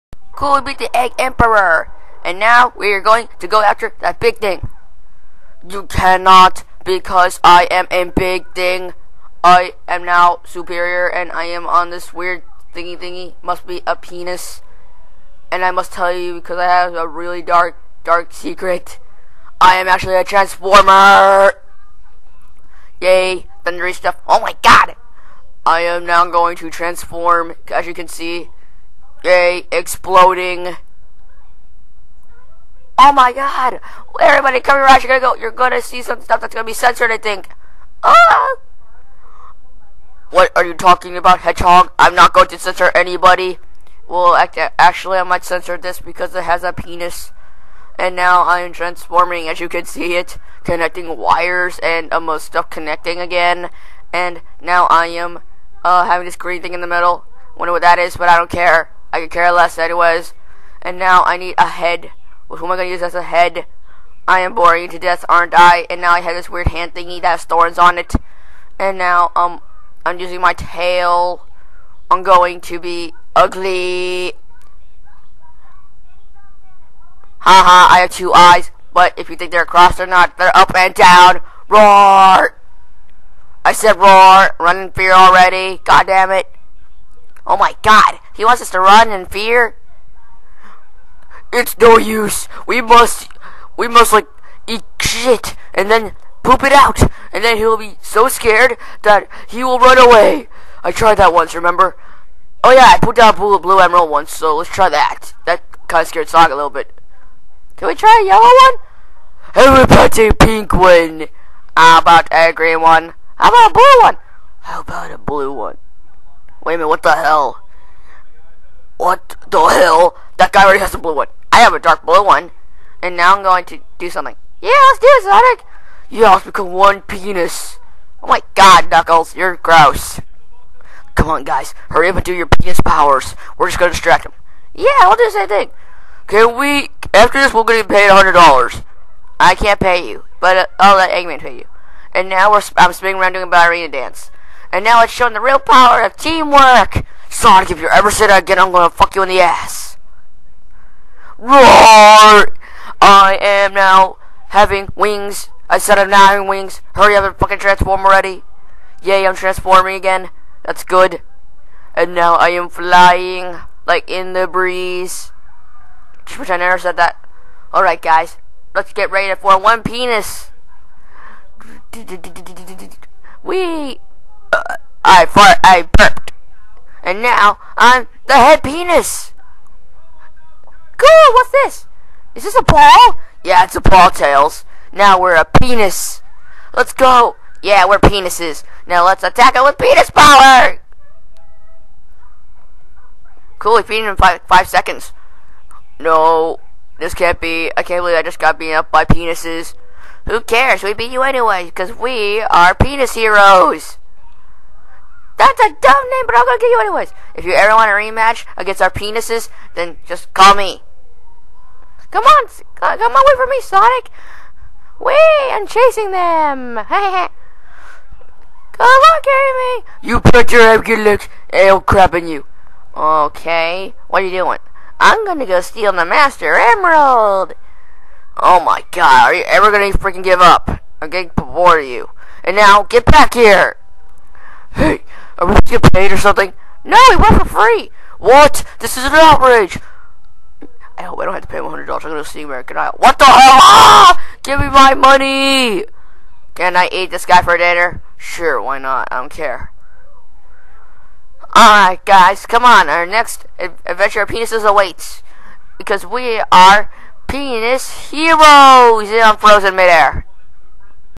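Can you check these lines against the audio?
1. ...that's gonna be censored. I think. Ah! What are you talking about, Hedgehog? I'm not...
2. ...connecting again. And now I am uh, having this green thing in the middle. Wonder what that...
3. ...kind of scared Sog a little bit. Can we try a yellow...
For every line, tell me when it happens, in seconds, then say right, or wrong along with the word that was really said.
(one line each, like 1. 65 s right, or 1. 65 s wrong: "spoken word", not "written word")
1. 36 s right
2. 52 s right
3. 105 s right.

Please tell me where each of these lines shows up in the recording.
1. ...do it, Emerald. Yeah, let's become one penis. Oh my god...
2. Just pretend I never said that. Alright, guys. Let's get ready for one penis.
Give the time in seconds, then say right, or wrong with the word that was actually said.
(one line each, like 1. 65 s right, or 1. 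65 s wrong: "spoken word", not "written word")
1. 124 s wrong: "Sonic", not "Emerald"
2. 166 s right.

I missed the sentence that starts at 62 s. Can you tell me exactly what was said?
who am I going to use as a head?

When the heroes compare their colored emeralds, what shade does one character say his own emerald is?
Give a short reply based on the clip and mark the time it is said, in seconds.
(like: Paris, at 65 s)
Dark blue, at 121 s.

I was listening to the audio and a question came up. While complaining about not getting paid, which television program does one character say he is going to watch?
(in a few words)
American Idol.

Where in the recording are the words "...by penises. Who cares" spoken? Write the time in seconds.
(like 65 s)
198 s.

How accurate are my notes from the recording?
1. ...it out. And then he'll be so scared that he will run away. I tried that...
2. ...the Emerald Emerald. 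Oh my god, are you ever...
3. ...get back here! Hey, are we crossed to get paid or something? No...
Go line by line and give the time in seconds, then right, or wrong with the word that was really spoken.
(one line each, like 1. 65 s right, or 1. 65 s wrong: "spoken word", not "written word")
1. 96 s right
2. 225 s wrong: "Master", not "Emerald"
3. 232 s wrong: "supposed", not "crossed".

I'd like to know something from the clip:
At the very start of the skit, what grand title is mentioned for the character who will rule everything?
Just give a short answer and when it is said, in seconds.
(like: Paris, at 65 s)
Egg Emperor, at 0 s.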